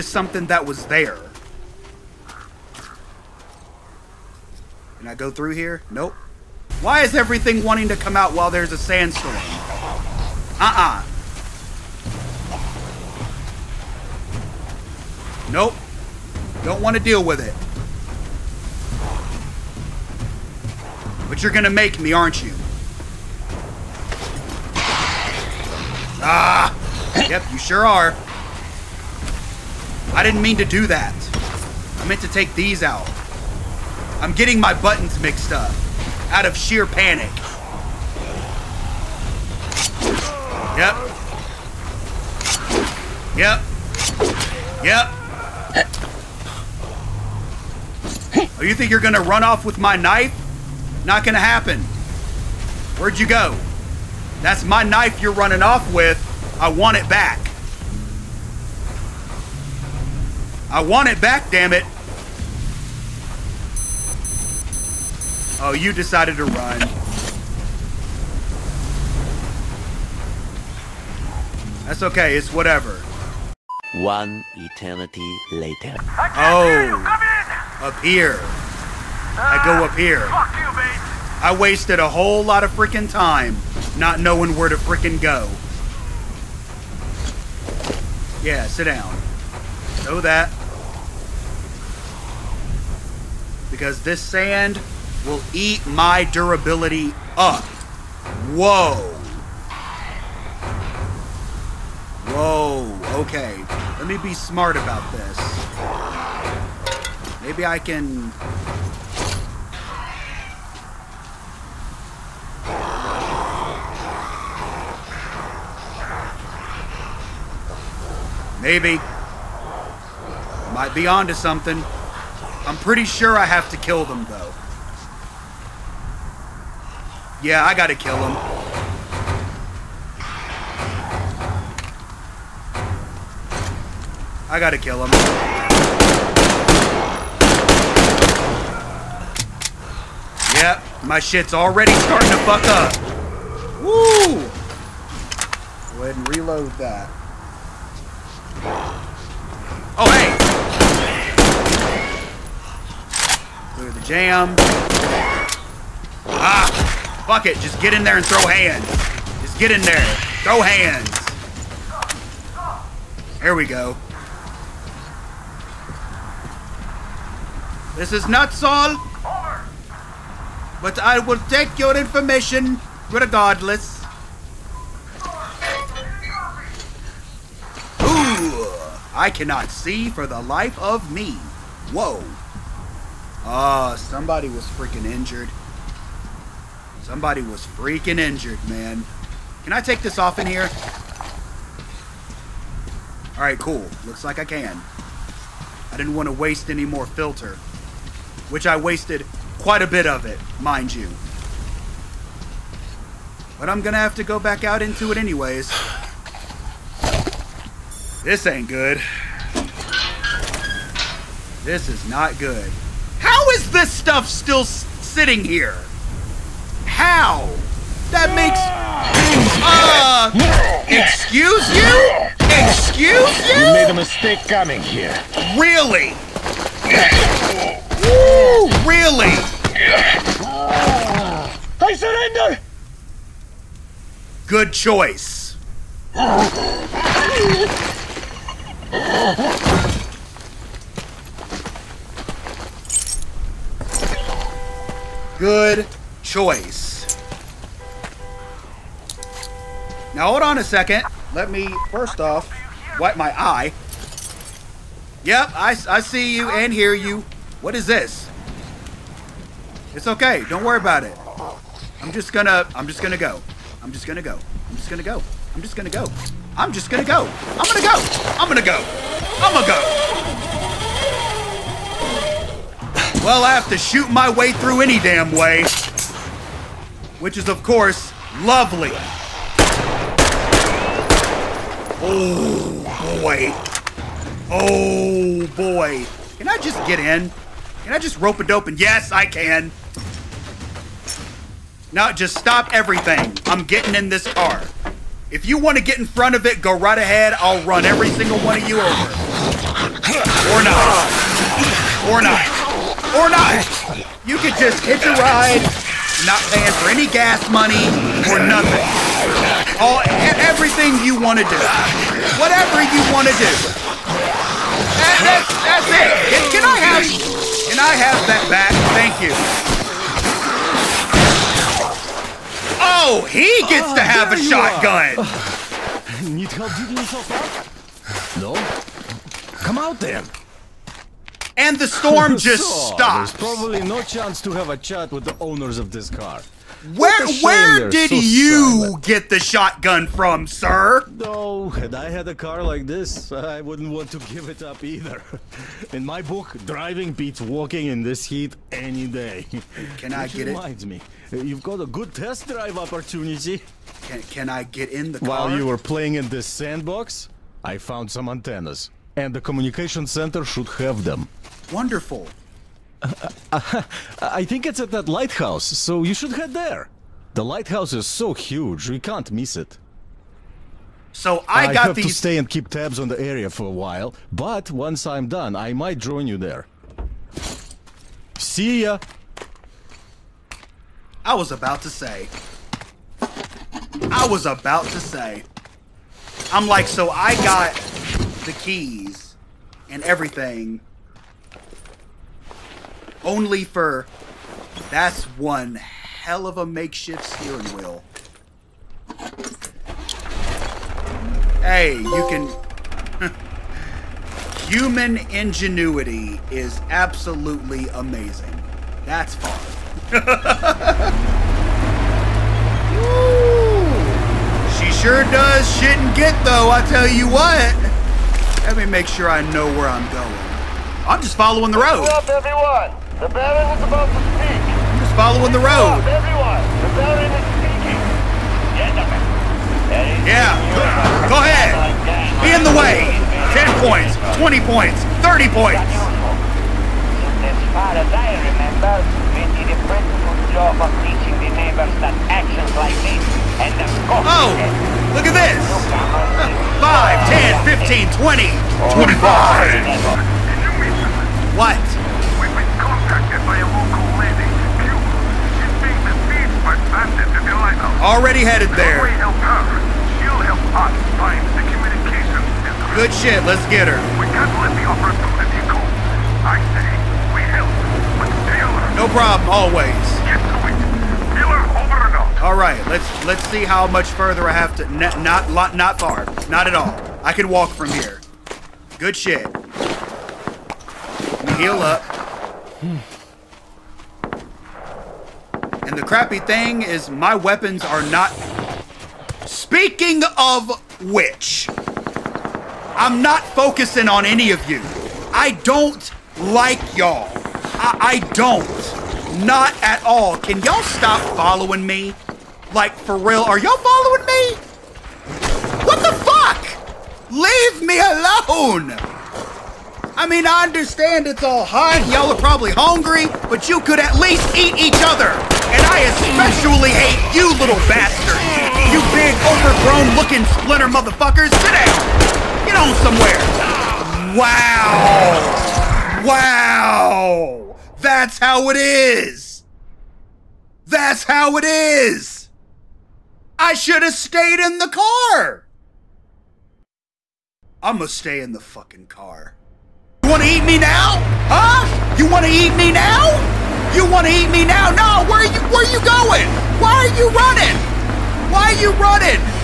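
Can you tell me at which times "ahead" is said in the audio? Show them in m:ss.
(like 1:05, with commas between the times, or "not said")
2:26, 4:56, 7:11.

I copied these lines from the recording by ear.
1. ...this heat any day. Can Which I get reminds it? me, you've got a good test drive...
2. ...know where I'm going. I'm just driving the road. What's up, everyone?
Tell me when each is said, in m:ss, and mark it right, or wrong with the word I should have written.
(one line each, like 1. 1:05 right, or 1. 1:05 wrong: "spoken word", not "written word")
1. 5:48 right
2. 6:59 wrong: "following", not "driving".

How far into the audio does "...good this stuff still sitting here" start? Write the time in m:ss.
3:32.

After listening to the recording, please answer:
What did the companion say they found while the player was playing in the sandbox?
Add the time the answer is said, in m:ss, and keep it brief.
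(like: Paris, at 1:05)
antennas, at 5:58.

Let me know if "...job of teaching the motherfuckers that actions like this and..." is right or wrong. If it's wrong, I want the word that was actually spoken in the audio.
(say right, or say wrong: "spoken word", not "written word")
wrong: "neighbors", not "motherfuckers".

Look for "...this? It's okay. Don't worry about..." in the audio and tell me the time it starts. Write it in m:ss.
4:17.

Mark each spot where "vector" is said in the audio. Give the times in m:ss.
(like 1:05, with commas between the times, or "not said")
not said.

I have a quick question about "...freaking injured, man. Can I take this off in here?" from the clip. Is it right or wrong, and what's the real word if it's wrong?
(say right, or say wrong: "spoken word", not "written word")
right.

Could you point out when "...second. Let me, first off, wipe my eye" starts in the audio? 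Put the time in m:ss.
4:10.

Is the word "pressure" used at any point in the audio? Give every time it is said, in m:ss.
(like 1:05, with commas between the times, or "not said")
not said.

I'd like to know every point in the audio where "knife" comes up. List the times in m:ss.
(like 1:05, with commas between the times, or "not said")
0:49, 0:54.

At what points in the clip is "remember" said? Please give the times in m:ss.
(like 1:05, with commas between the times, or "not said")
7:18.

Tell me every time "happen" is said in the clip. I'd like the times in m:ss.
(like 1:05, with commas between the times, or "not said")
0:51.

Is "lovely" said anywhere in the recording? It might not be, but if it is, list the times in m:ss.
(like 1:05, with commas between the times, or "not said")
4:38.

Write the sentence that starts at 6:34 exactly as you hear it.
That's one hell of a makeshift steering wheel.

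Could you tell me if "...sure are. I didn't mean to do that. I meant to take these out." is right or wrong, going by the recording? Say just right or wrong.
right.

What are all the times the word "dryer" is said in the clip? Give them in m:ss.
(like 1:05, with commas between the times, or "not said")
not said.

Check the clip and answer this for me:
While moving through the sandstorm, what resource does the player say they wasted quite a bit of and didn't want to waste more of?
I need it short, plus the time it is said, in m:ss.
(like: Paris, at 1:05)
filter, at 3:17.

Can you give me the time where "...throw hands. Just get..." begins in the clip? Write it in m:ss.
2:38.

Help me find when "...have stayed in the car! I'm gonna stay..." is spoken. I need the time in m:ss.
8:54.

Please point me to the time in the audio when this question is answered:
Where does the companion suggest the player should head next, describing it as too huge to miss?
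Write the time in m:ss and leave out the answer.
6:04.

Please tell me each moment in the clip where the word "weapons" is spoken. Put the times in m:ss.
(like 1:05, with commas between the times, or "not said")
8:07.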